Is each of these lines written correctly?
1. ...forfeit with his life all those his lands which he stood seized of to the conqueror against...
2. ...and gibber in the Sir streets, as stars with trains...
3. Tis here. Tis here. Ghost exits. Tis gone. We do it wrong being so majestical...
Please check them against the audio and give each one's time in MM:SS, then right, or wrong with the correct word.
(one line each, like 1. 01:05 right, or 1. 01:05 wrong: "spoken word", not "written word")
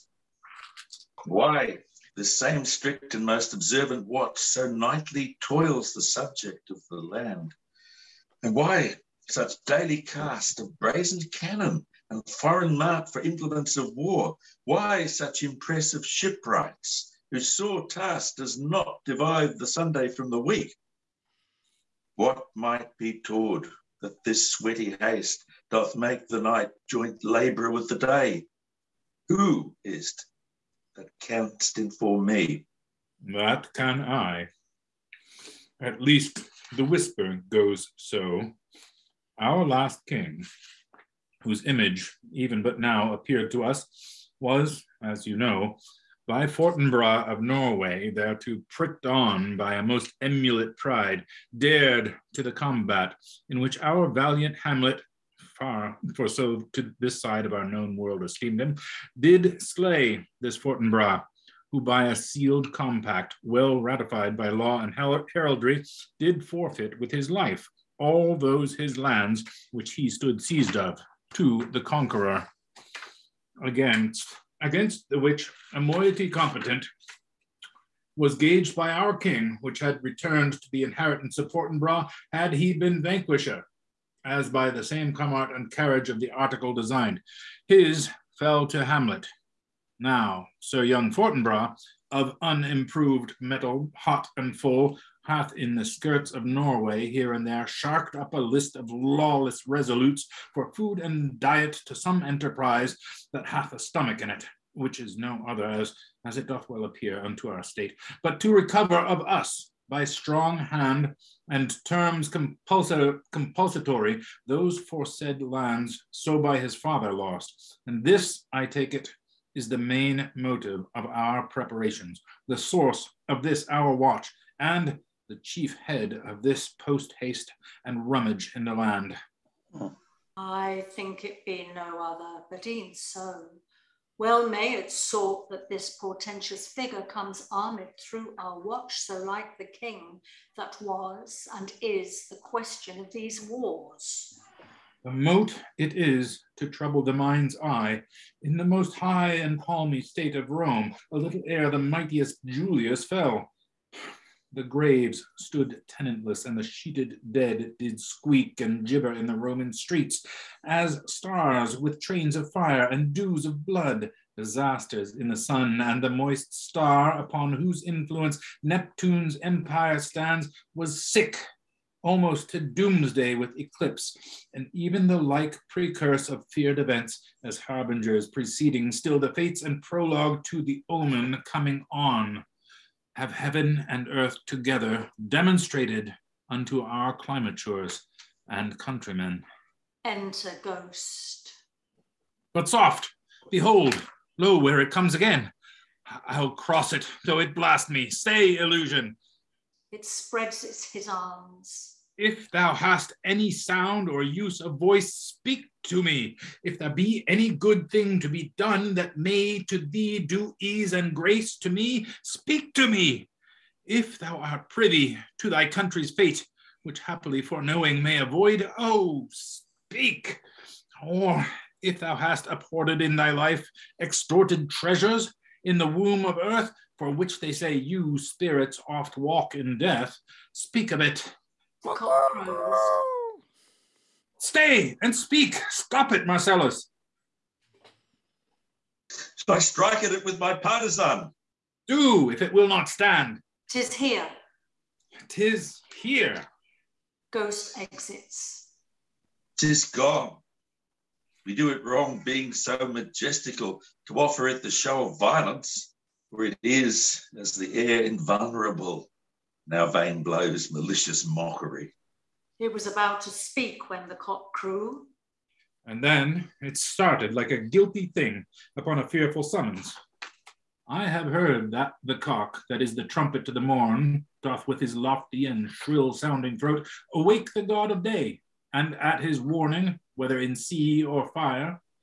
1. 01:06 right
2. 02:38 wrong: "Roman", not "Sir"
3. 04:03 right.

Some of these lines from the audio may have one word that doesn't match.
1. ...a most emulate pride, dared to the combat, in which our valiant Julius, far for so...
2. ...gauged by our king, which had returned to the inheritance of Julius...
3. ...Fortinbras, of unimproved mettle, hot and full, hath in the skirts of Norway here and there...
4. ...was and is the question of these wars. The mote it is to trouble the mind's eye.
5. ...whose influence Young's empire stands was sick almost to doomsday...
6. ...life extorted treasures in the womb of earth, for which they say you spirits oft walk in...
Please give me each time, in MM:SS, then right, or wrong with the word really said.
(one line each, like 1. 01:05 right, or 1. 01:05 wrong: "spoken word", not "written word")
1. 00:49 wrong: "Hamlet", not "Julius"
2. 01:18 wrong: "Fortinbras", not "Julius"
3. 01:31 right
4. 02:20 right
5. 02:47 wrong: "Neptune", not "Young"
6. 03:43 right.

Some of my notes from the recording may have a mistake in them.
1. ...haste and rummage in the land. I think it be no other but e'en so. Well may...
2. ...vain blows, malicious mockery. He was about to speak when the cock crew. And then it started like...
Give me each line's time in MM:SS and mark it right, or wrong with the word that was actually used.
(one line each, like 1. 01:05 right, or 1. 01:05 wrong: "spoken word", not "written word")
1. 02:07 right
2. 04:19 right.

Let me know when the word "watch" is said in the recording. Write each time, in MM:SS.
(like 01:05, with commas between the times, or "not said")
00:04, 02:03, 02:18.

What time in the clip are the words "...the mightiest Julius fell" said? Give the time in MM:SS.
02:31.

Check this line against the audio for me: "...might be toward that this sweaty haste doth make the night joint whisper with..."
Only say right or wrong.
wrong.